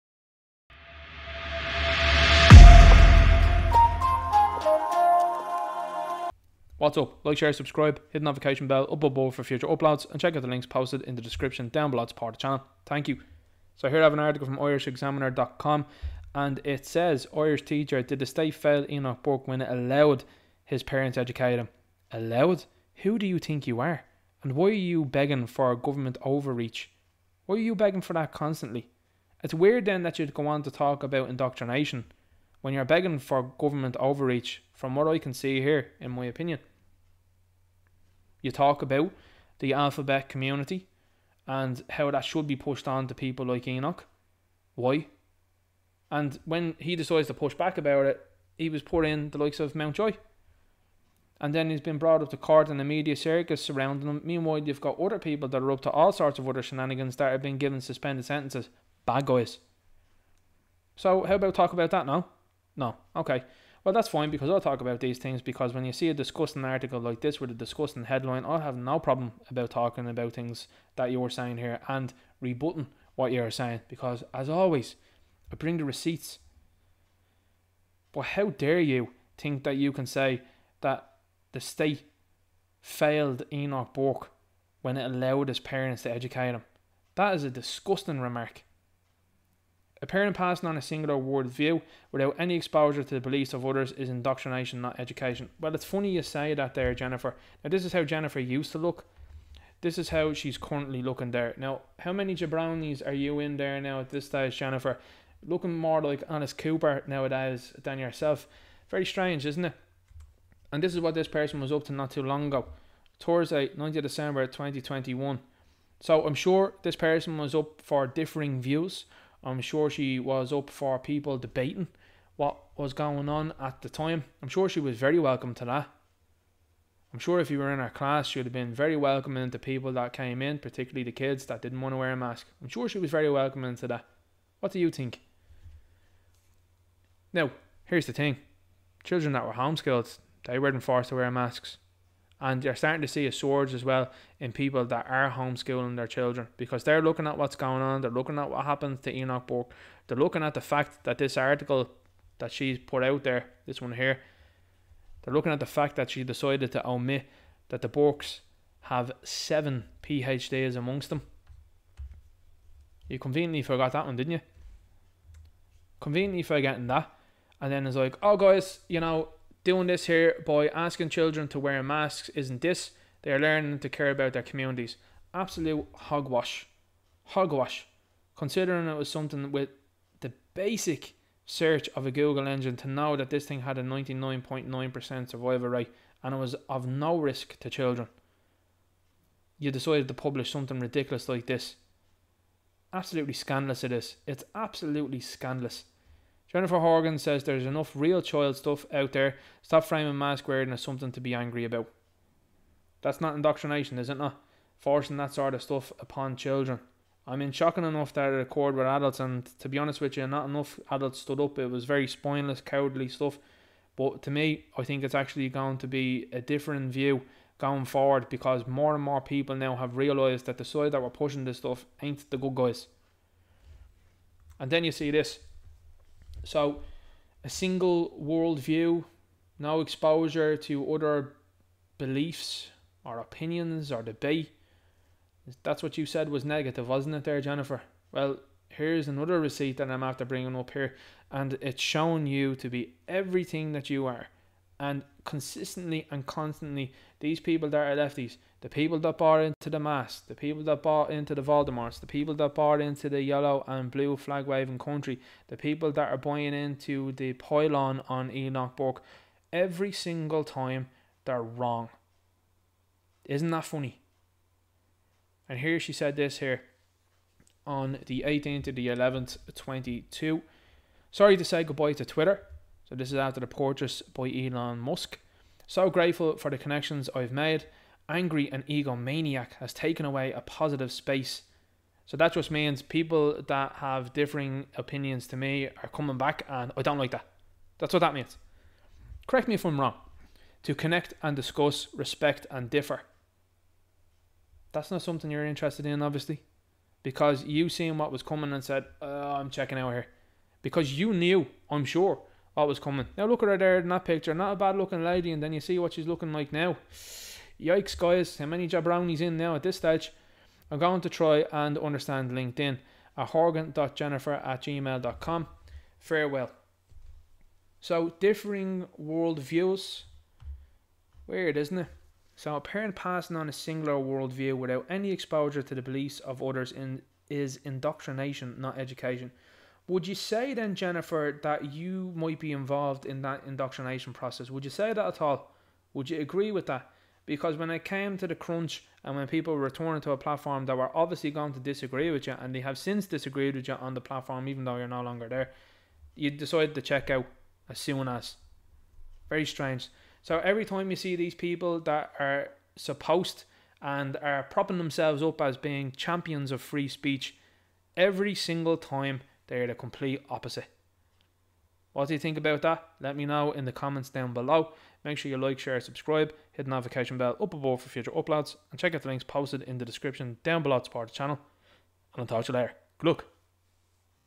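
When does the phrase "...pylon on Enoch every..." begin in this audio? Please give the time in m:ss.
4:17.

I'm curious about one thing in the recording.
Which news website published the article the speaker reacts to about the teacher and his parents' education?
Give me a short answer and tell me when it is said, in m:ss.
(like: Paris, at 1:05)
IrishExaminer.com, at 0:14.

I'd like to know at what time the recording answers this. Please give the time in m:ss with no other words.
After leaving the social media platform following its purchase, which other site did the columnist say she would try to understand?
5:12.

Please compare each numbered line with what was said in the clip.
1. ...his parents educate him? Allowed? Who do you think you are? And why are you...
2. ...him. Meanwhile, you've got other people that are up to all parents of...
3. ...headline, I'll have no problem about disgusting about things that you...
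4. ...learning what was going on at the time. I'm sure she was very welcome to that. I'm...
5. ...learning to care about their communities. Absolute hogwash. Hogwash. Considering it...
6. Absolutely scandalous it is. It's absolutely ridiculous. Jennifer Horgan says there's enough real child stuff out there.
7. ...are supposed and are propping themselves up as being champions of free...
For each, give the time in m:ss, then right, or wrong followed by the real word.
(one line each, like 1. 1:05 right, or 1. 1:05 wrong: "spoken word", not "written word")
1. 0:20 right
2. 0:54 wrong: "sorts", not "parents"
3. 1:08 wrong: "talking", not "disgusting"
4. 2:01 wrong: "debating", not "learning"
5. 2:53 right
6. 3:12 wrong: "scandalous", not "ridiculous"
7. 5:52 right.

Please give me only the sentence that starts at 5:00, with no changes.
Because you knew, I'm sure, what was coming.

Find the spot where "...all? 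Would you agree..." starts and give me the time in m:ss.
5:35.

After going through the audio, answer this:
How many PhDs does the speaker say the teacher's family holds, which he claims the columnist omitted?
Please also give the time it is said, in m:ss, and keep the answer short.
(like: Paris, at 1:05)
7, at 2:39.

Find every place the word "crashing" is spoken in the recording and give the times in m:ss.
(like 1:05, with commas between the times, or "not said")
not said.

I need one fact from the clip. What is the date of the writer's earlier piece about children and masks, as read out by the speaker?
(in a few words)
Thursday, 9th December 2021.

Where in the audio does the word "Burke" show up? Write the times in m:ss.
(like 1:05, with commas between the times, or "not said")
0:19, 1:23, 2:29, 2:37.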